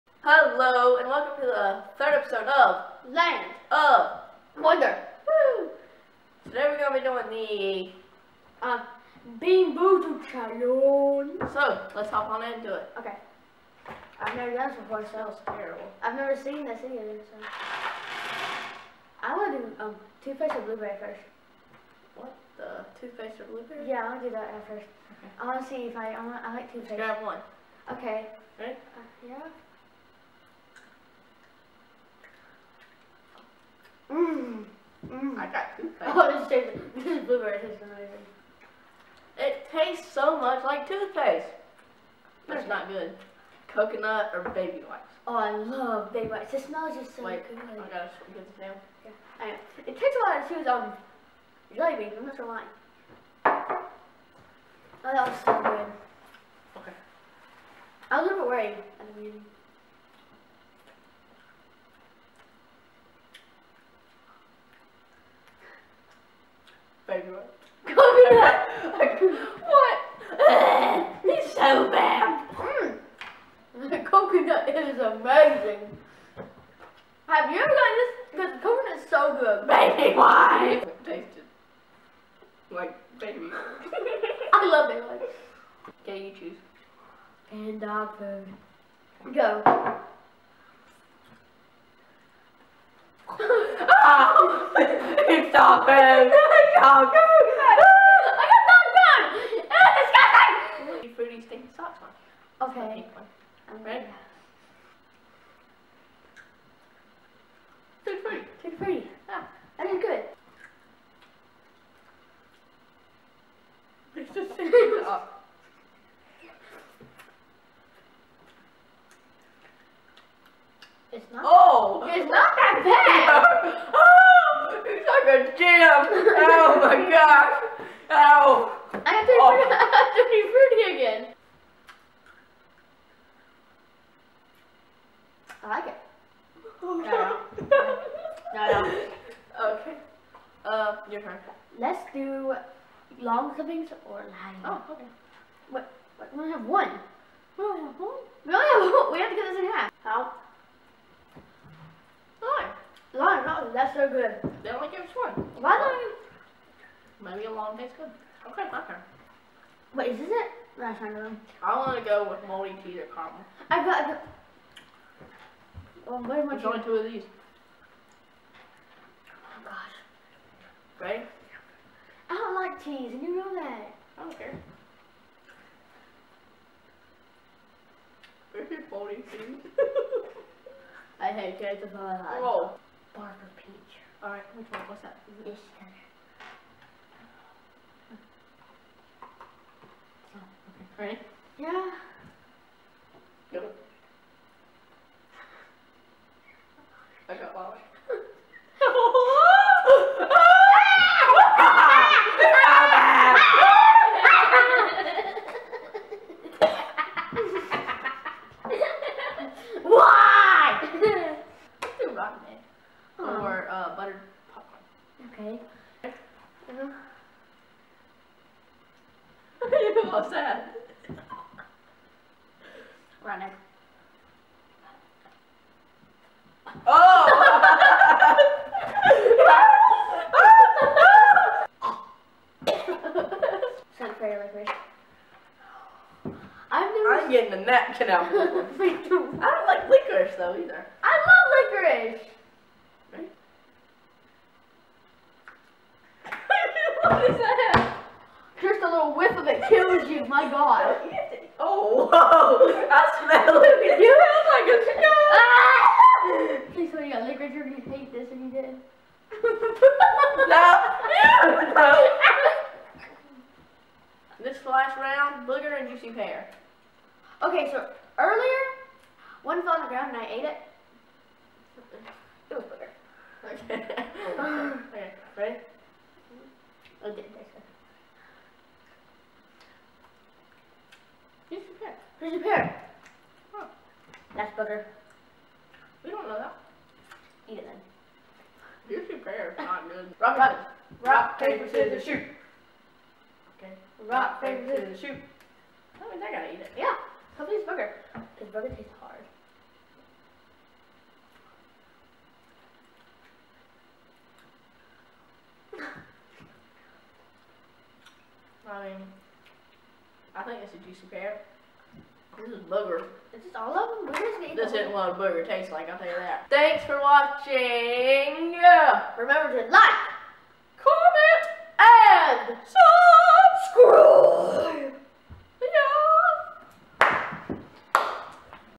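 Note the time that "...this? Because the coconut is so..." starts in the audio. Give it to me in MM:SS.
01:17.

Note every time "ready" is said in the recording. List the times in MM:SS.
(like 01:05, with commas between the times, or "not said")
00:28, 01:43, 03:10, 04:35.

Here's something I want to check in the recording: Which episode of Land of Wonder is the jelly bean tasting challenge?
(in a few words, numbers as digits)
third.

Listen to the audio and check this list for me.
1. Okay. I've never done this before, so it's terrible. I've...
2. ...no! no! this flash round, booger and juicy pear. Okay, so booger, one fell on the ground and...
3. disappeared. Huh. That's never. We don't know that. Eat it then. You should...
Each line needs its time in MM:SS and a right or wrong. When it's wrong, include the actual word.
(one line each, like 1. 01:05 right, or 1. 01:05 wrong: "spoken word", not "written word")
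1. 00:12 right
2. 04:20 wrong: "earlier", not "booger"
3. 04:42 wrong: "booger", not "never".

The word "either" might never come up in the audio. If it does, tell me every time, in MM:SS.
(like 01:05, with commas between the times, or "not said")
00:16, 04:00.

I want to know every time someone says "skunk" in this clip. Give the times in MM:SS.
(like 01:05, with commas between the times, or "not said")
04:16.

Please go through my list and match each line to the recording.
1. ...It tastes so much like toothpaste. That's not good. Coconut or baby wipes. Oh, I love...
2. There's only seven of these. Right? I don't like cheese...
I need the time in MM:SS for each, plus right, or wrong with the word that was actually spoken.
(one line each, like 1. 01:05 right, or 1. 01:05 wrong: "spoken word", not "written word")
1. 00:39 right
2. 02:46 wrong: "two", not "seven".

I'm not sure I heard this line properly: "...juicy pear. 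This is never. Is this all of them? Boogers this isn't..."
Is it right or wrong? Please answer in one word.
wrong.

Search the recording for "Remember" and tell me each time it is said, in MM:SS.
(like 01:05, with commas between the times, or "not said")
05:19.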